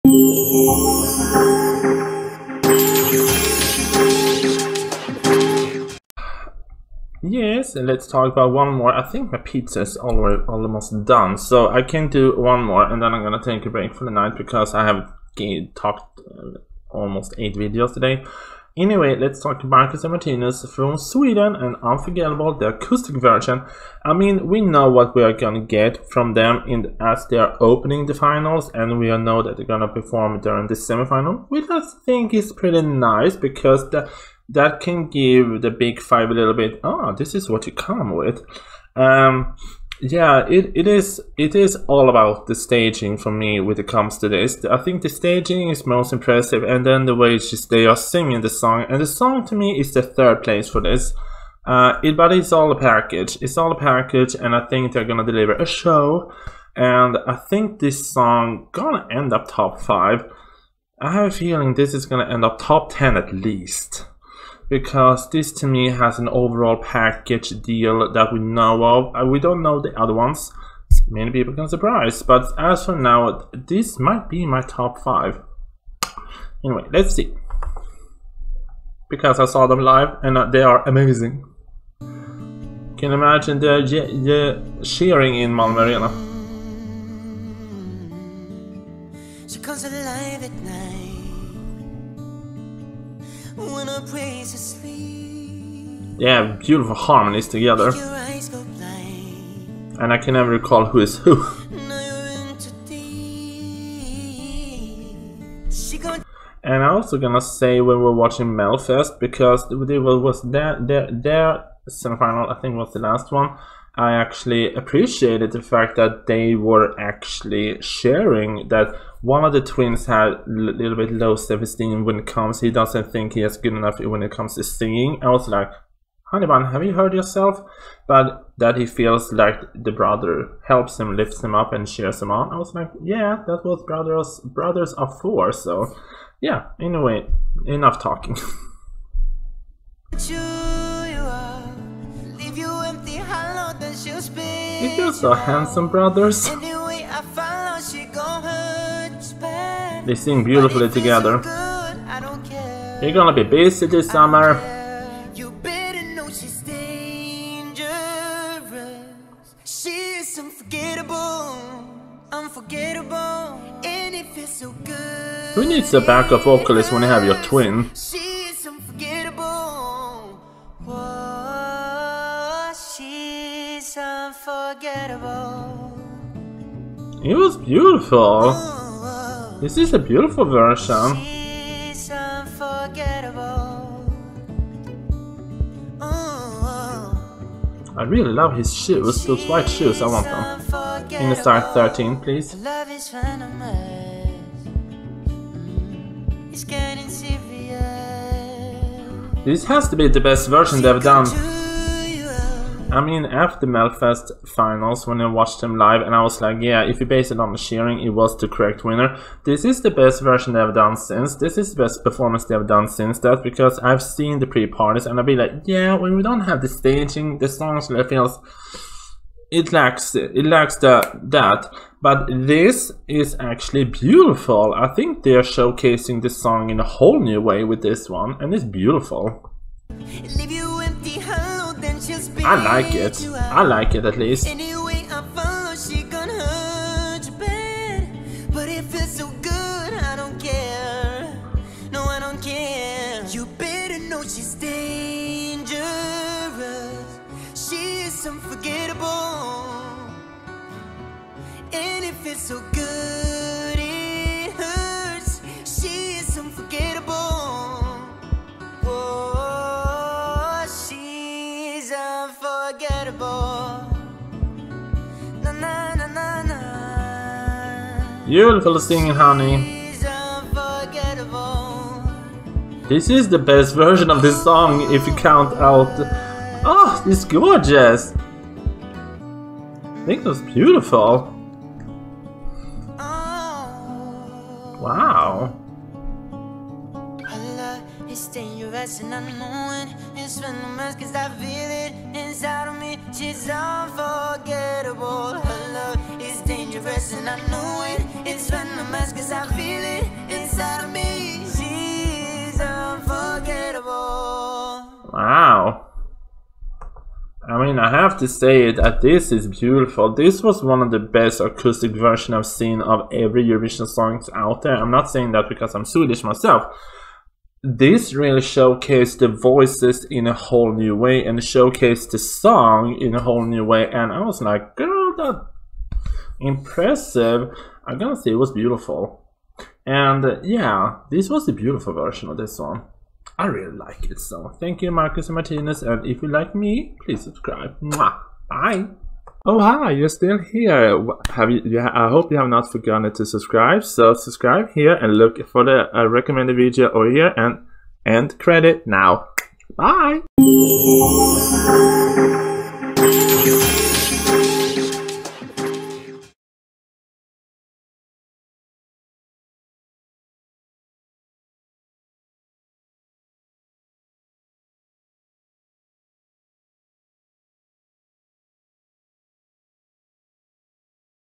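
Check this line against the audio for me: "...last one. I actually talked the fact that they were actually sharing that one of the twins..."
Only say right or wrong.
wrong.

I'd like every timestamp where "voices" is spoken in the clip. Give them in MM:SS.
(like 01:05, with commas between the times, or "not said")
05:19.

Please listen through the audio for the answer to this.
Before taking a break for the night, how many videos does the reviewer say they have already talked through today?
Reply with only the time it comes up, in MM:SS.
00:17.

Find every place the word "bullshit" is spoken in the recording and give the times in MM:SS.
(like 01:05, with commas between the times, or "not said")
not said.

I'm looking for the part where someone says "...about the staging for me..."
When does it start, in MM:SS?
00:42.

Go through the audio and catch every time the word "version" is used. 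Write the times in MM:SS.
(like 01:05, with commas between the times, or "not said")
00:23, 03:00, 03:20, 03:30, 04:33, 05:12, 05:31.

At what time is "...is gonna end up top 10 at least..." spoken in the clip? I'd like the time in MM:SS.
01:01.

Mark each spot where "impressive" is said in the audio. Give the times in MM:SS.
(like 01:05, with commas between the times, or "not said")
00:46, 05:26.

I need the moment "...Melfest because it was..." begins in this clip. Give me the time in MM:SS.
01:48.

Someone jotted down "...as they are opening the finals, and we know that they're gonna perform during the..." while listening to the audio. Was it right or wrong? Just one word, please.
right.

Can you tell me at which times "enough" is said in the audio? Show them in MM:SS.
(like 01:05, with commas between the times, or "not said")
02:03, 02:17.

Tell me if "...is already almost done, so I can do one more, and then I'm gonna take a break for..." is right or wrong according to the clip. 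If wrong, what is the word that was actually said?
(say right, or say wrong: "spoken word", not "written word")
right.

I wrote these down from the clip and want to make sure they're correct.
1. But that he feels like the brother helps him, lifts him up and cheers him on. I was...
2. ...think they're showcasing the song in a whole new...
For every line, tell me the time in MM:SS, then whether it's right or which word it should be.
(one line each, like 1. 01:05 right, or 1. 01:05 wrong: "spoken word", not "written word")
1. 02:08 right
2. 03:44 right.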